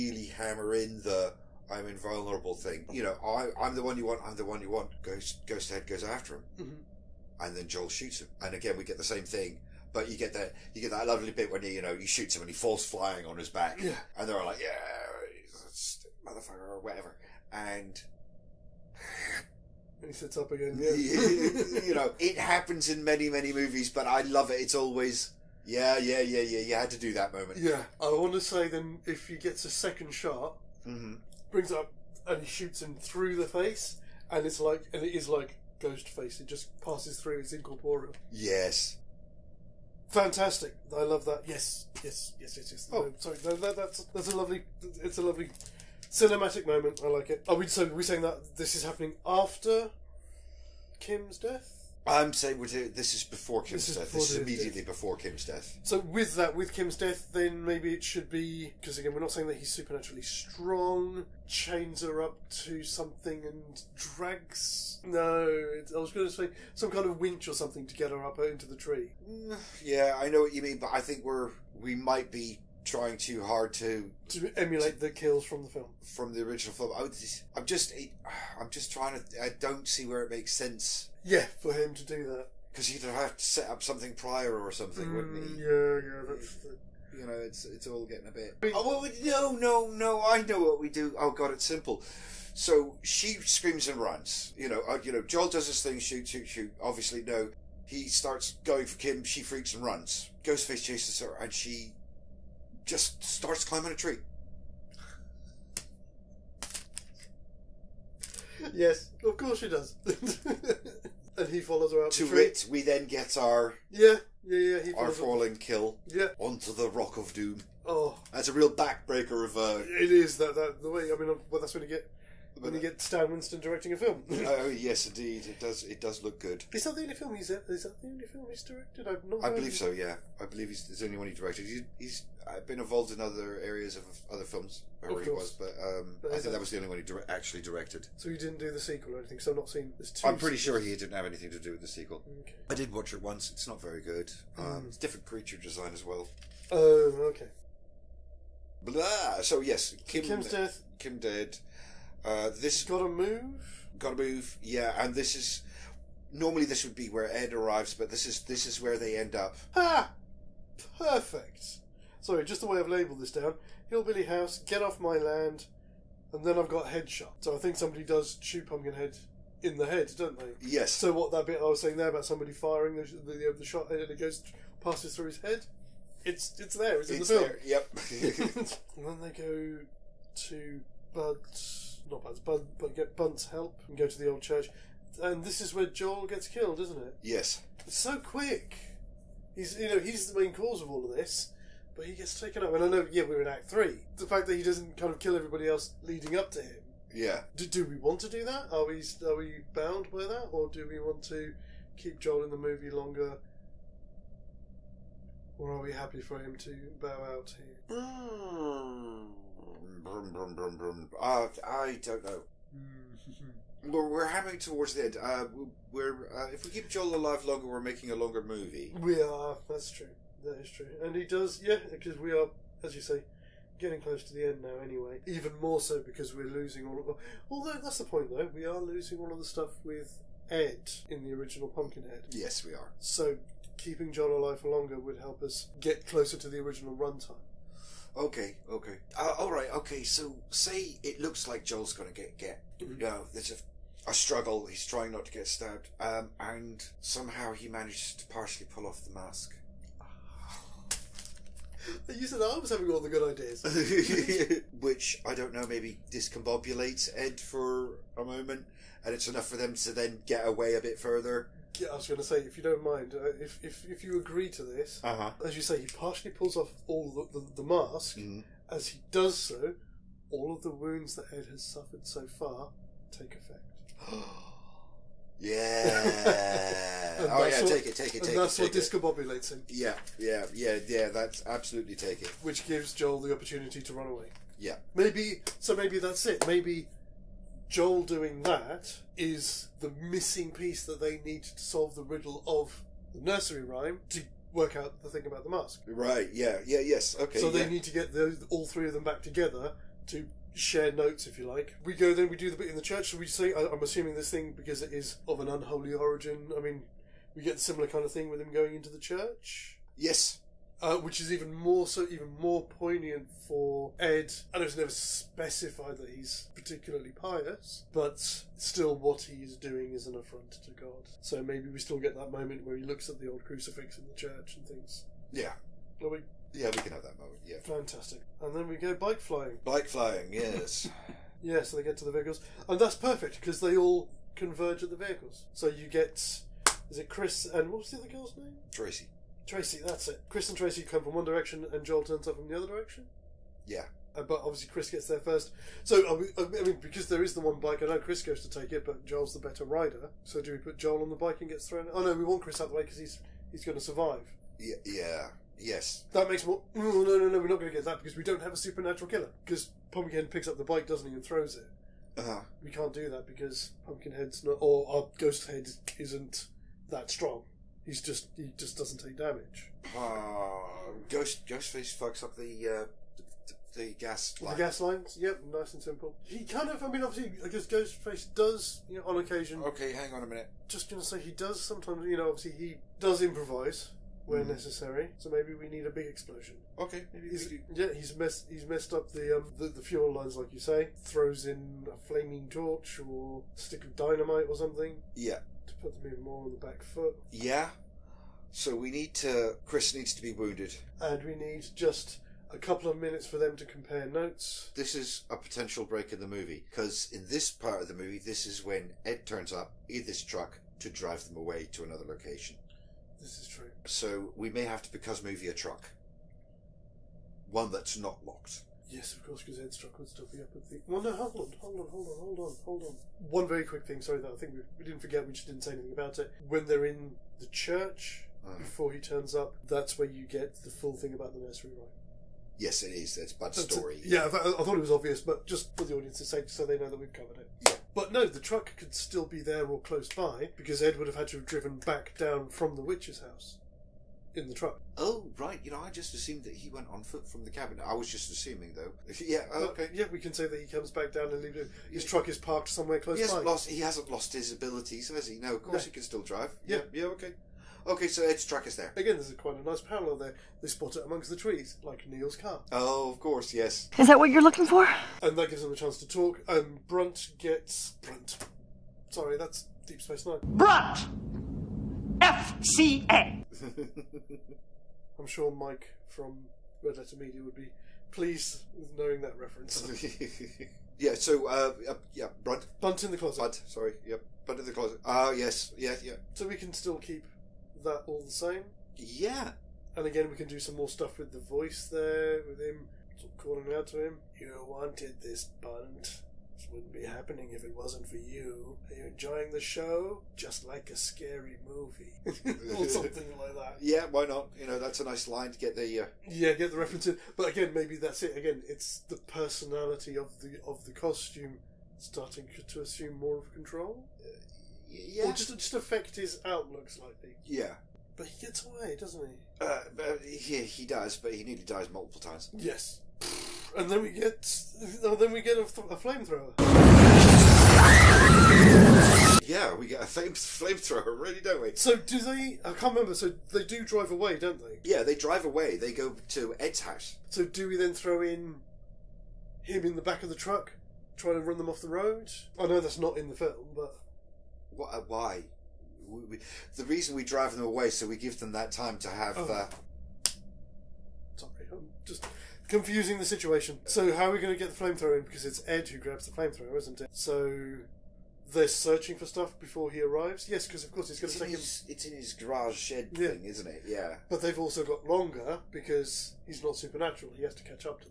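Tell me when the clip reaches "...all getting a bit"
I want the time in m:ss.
1:27.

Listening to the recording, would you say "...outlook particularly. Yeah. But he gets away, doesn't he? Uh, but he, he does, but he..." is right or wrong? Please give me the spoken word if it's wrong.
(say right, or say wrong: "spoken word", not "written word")
wrong: "slightly", not "particularly".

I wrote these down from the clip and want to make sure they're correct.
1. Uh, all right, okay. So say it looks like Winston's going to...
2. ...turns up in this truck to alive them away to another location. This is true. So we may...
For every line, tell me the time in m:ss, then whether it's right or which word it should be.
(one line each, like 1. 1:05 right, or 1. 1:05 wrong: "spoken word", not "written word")
1. 3:59 wrong: "Joel", not "Winston"
2. 6:49 wrong: "drive", not "alive".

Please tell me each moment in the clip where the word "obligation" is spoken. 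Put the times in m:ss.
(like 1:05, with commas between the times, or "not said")
not said.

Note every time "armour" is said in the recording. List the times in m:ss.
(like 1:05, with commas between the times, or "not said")
not said.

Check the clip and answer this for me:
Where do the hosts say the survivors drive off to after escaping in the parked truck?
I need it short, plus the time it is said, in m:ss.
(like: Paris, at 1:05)
Ed's house, at 8:56.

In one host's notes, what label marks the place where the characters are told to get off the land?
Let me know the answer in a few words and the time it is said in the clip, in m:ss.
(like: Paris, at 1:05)
Hillbilly house, at 2:43.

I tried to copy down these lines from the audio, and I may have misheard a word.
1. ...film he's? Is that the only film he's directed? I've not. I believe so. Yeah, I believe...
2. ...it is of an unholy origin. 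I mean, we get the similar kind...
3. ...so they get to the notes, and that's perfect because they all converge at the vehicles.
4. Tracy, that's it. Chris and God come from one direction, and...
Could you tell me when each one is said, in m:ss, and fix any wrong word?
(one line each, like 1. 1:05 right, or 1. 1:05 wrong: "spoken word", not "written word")
1. 2:07 right
2. 5:04 right
3. 5:31 wrong: "vehicles", not "notes"
4. 5:39 wrong: "Tracy", not "God".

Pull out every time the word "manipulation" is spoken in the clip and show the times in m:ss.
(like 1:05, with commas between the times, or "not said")
not said.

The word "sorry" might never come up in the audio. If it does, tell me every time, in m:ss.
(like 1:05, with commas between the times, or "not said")
0:43, 2:42, 7:04, 7:49, 8:03, 9:11.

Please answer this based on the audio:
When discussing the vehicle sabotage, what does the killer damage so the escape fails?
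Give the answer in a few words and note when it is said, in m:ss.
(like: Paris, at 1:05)
The gas lines, at 6:14.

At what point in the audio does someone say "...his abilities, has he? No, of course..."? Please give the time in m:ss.
7:34.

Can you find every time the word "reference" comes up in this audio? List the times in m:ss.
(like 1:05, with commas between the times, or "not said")
7:59, 8:26.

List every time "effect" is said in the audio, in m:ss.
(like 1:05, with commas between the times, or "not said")
4:33.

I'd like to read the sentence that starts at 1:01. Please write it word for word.
Chains her up to something and drags.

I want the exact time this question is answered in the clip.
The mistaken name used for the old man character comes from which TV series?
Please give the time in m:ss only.
7:49.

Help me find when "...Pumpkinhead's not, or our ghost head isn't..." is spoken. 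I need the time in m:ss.
6:03.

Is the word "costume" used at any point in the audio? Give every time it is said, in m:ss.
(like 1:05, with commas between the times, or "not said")
8:30.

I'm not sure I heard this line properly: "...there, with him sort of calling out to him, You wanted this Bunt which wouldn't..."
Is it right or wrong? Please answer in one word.
right.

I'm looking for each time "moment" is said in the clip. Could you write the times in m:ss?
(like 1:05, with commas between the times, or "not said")
0:27, 0:46, 4:18, 5:22, 5:27.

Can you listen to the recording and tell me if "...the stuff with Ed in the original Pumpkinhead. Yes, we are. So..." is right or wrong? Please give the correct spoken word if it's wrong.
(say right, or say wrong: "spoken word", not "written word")
right.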